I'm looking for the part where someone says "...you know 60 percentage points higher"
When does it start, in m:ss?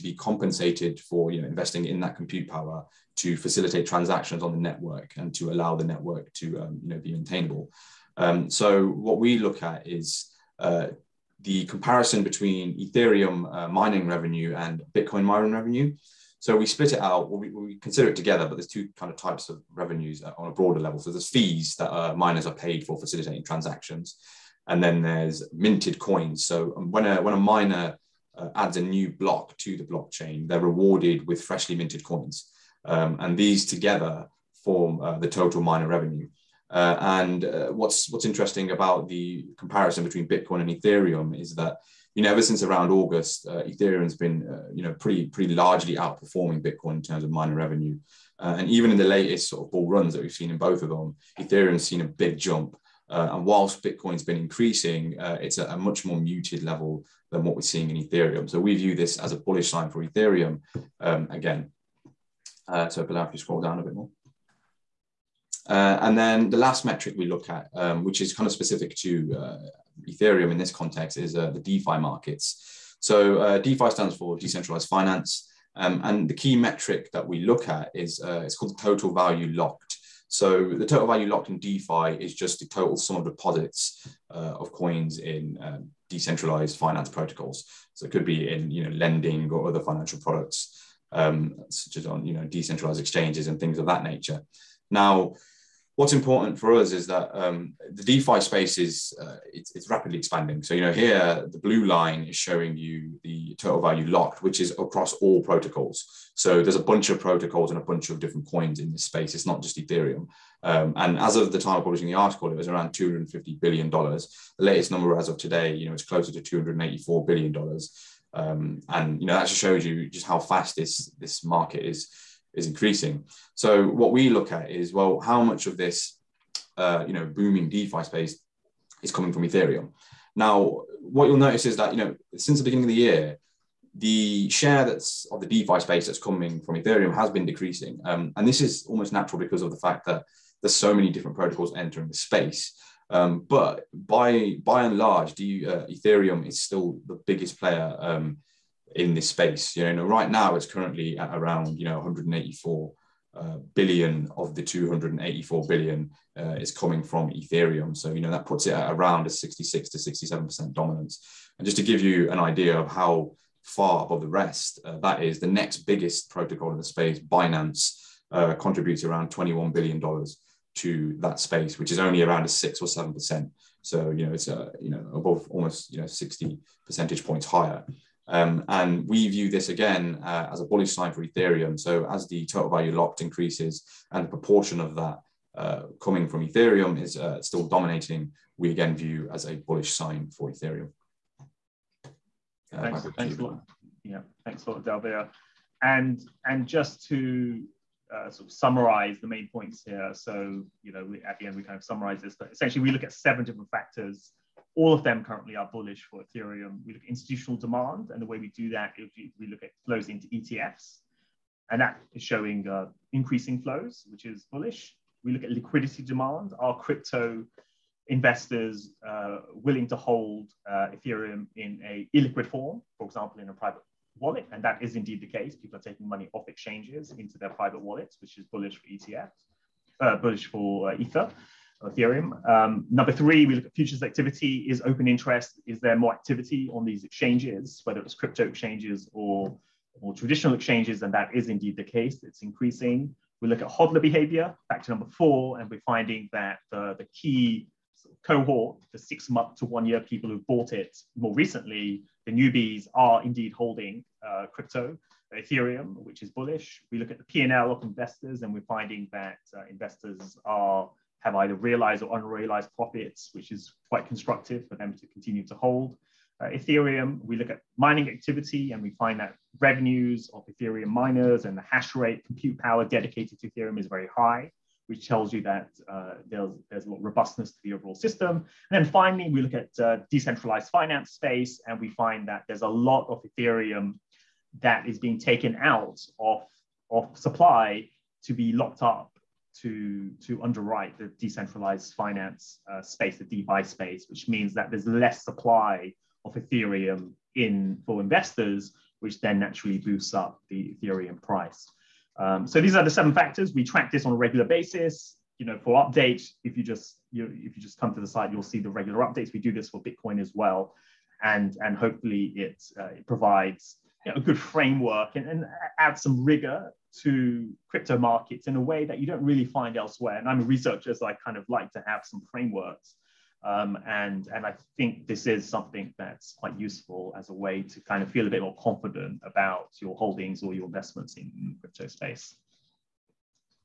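2:55.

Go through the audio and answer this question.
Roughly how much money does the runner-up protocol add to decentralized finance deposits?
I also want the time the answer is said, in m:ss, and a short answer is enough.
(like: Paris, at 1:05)
$21 billion, at 2:49.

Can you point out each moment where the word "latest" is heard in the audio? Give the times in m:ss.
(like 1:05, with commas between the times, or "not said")
0:49, 1:54.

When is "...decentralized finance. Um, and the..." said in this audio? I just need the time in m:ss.
1:14.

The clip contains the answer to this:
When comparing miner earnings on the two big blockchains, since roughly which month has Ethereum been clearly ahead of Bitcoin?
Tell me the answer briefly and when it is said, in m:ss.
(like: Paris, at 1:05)
August, at 0:42.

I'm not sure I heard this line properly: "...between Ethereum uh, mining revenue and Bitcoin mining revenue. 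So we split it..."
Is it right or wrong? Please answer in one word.
right.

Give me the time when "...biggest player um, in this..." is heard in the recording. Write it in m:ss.
2:27.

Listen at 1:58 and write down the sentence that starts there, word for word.
Um, and you know that just shows you just how fast this this market is is increasing.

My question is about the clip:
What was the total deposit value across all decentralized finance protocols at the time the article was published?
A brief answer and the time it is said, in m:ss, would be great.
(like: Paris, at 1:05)
$250 billion, at 1:52.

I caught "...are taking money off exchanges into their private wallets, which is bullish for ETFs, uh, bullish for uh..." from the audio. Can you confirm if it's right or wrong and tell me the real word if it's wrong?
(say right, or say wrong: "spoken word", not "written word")
right.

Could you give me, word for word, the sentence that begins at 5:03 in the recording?
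We track this on a regular basis.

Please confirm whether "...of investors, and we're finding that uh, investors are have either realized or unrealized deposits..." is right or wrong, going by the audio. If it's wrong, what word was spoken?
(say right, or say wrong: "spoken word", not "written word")
wrong: "profits", not "deposits".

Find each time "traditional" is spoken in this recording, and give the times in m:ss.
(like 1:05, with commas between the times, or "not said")
4:00.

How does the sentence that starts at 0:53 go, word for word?
Uh, and whilst Bitcoin's been increasing, uh, it's at a, much more muted level than what we're seeing in Ethereum.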